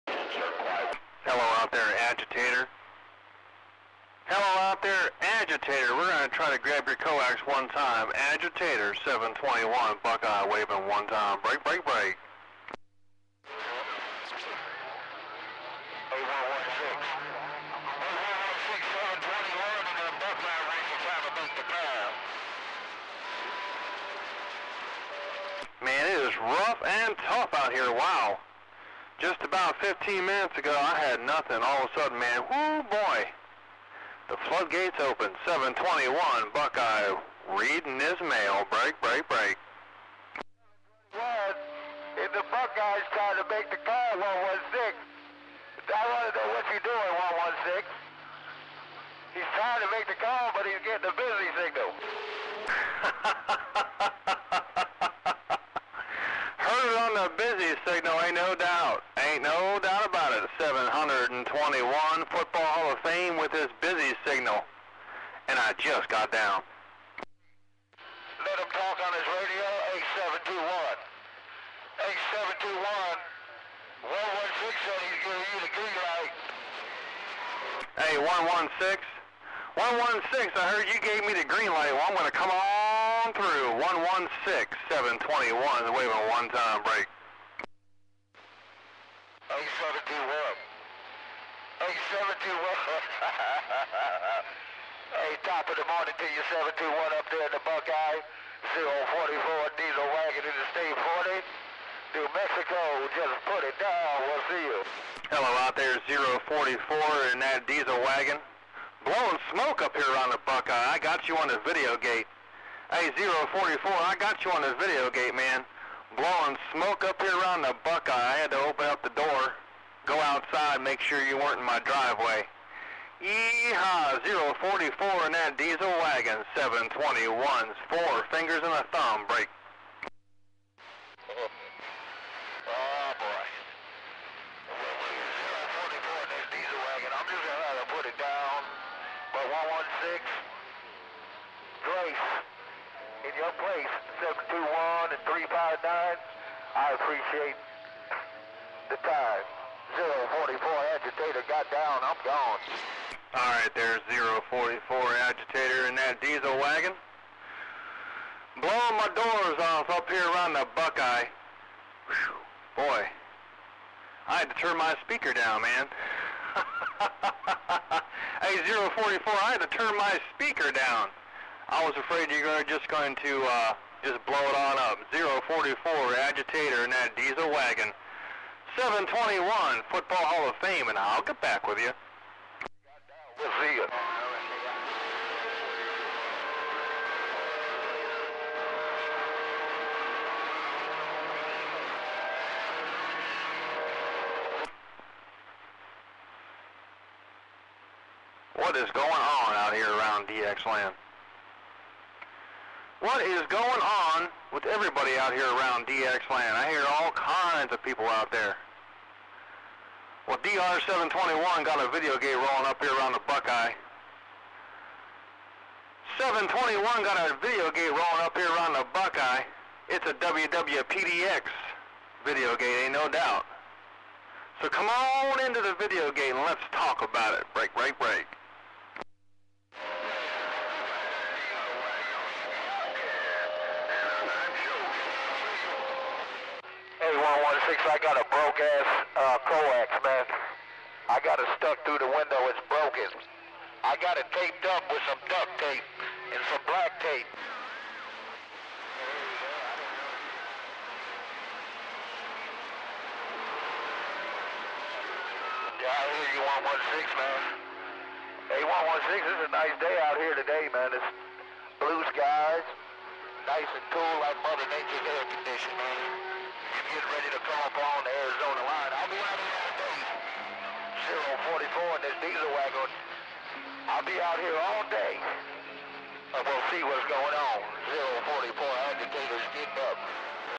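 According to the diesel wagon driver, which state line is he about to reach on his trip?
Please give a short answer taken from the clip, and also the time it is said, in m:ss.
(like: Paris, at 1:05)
Arizona, at 4:28.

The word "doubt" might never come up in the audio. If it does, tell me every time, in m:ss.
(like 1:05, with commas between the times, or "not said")
3:43.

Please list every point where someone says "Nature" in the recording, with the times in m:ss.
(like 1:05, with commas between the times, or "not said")
4:24.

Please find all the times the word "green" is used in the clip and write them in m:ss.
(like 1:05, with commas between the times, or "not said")
1:15, 1:21.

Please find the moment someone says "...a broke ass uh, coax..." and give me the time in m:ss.
3:58.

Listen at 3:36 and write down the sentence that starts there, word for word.
721 got a video gate rolling up here around the Buckeye.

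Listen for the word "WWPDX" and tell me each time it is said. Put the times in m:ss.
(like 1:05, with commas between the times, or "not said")
3:40.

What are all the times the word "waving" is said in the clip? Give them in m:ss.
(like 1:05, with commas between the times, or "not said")
0:10, 1:25.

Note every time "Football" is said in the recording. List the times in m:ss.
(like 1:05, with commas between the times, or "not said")
1:02, 2:59.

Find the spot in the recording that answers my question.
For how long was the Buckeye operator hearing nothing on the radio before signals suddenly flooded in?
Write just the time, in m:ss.
0:29.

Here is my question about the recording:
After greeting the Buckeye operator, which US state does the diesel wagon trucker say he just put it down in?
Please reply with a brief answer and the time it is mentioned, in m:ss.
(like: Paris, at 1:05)
New Mexico, at 1:42.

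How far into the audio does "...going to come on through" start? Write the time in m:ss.
1:22.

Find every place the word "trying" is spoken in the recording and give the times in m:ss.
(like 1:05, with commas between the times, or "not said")
0:43, 0:49.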